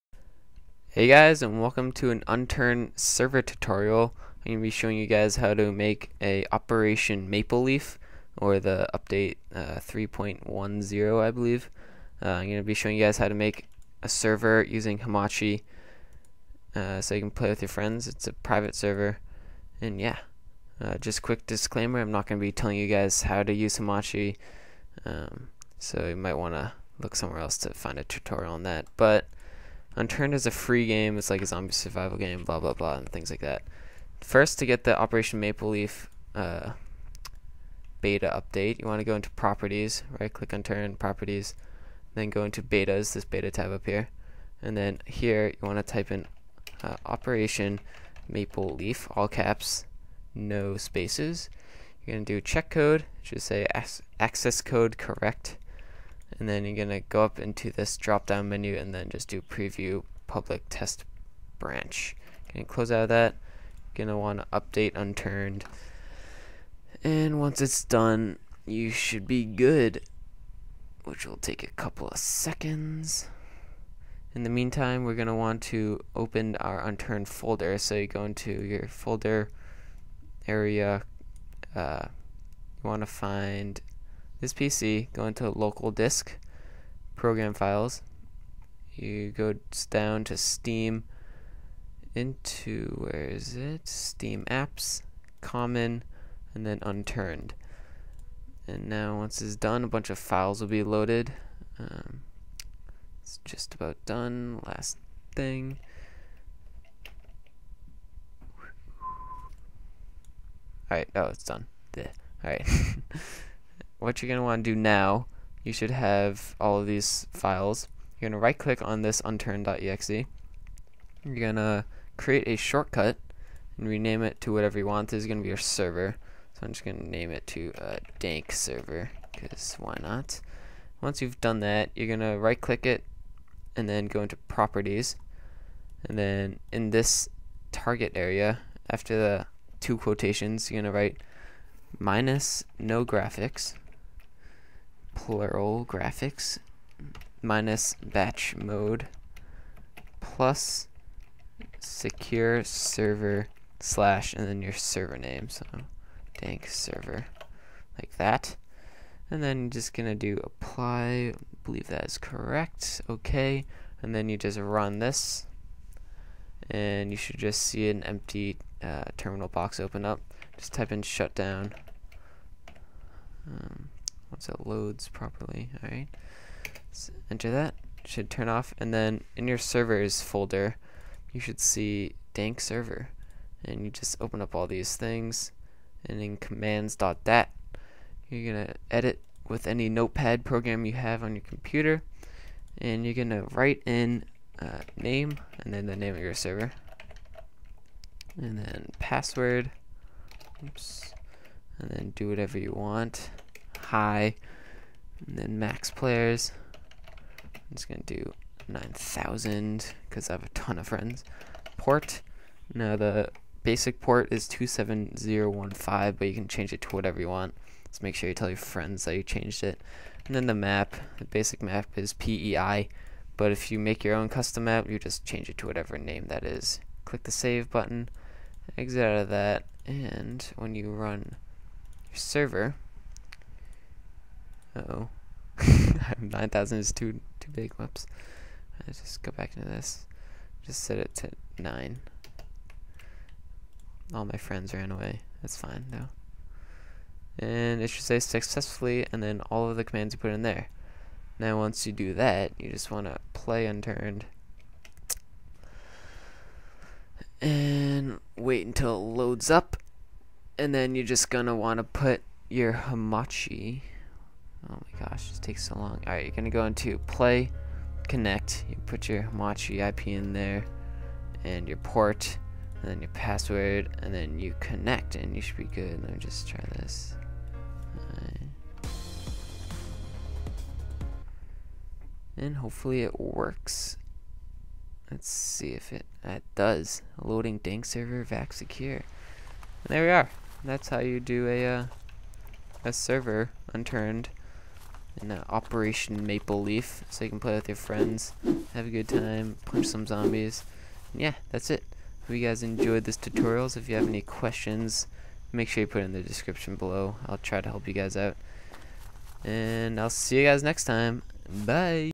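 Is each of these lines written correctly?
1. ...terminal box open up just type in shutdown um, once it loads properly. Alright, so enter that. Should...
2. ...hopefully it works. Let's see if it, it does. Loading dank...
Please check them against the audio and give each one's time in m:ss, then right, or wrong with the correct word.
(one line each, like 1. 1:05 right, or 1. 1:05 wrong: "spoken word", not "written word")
1. 2:49 right
2. 4:42 right.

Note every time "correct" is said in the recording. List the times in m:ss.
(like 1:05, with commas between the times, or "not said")
0:54, 2:42.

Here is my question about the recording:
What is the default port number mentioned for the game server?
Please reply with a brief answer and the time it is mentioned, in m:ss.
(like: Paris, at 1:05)
27015, at 3:34.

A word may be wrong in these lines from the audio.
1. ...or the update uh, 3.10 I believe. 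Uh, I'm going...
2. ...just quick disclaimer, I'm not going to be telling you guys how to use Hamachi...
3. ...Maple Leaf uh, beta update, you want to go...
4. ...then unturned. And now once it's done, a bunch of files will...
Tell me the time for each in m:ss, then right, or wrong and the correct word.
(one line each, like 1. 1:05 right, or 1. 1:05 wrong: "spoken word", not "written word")
1. 0:08 right
2. 0:20 right
3. 0:35 right
4. 1:36 right.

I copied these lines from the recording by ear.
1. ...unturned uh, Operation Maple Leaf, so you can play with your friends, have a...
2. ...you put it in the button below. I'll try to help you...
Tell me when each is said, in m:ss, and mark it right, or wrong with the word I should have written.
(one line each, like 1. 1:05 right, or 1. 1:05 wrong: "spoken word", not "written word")
1. 4:53 right
2. 5:05 wrong: "description", not "button".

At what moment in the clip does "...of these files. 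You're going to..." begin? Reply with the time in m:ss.
1:56.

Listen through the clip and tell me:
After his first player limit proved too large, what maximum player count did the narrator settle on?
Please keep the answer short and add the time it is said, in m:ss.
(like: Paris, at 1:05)
9, at 4:00.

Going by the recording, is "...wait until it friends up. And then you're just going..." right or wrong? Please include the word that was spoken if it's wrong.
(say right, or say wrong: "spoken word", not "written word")
wrong: "loads", not "friends".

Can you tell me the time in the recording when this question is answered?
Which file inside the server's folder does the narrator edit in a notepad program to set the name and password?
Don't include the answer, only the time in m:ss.
3:06.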